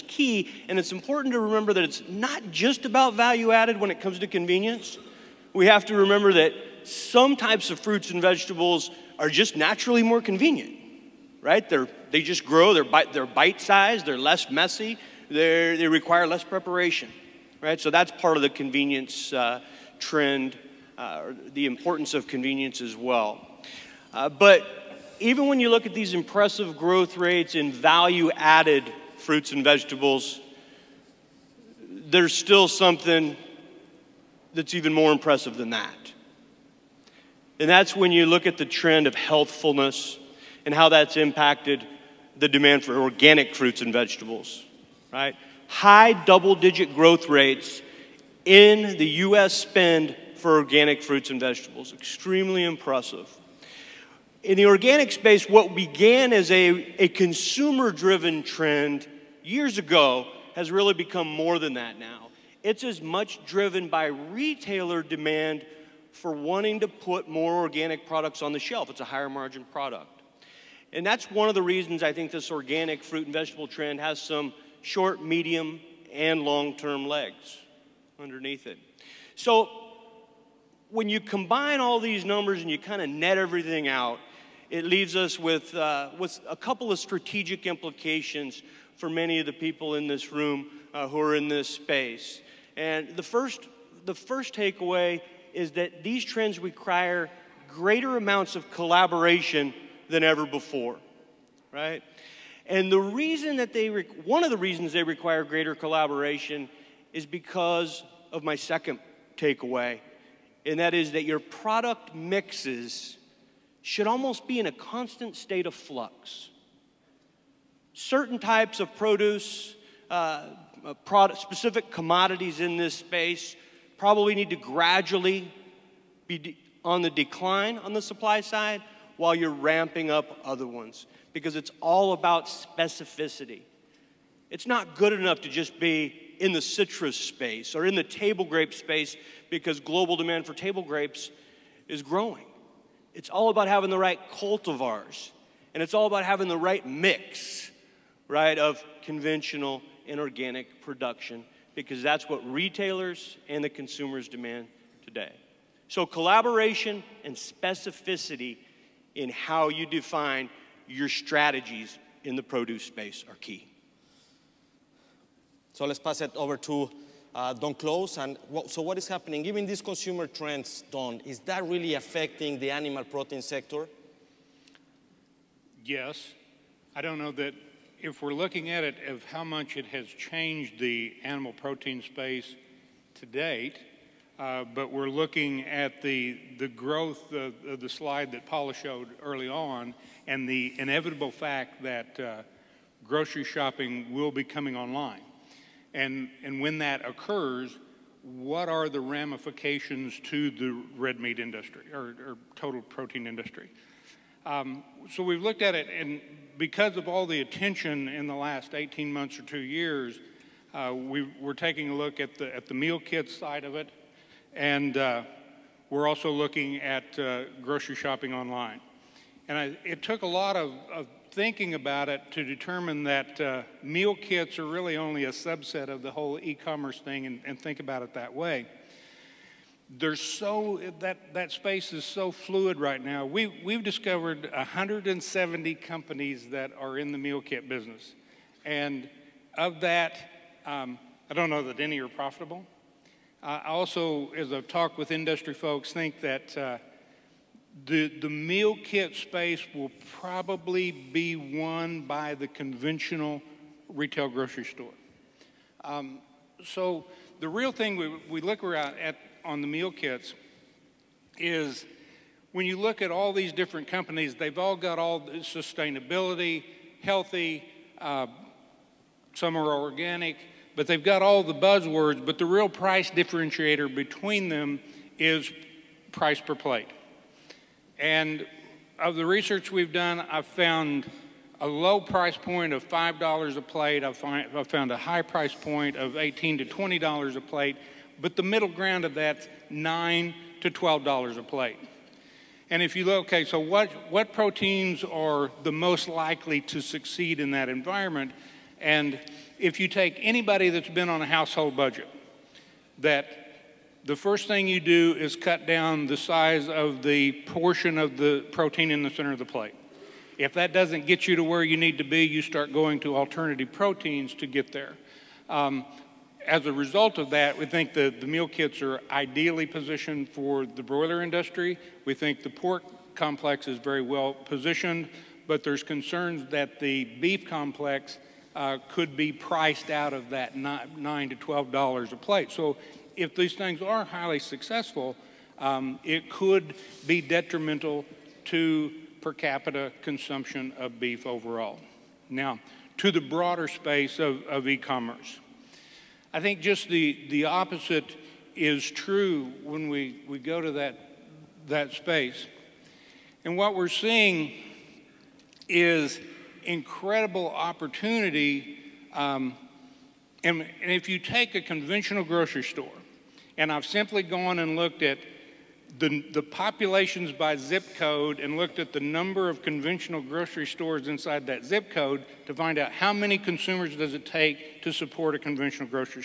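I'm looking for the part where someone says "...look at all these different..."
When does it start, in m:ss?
4:22.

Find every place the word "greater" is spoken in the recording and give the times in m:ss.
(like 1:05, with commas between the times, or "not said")
1:37, 1:45.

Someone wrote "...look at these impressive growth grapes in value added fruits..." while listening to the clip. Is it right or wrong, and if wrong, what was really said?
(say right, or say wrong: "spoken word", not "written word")
wrong: "rates", not "grapes".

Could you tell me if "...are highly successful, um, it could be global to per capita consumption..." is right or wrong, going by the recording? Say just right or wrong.
wrong.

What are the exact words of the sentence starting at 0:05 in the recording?
We have to remember that some types of fruits and vegetables are just naturally more convenient, right?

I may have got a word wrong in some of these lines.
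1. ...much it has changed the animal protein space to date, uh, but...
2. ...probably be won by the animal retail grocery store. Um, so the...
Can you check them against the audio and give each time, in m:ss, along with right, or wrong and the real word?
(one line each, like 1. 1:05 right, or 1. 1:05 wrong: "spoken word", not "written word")
1. 2:59 right
2. 4:10 wrong: "conventional", not "animal".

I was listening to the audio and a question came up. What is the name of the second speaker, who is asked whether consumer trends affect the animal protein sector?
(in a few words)
Don Close.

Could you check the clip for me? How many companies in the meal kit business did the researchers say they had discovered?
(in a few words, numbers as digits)
170.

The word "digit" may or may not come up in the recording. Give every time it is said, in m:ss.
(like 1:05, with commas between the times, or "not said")
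0:46.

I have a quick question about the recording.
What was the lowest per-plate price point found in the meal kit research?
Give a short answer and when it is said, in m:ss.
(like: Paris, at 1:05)
$5, at 4:42.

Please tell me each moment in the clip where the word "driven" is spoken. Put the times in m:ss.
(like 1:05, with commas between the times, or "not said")
0:57, 1:03.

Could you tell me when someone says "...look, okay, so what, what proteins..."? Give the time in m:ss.
4:53.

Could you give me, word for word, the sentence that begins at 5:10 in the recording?
If that doesn't get you to where you need to be, you start going to alternative proteins to get there.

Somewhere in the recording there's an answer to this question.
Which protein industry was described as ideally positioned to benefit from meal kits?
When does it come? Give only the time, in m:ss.
5:20.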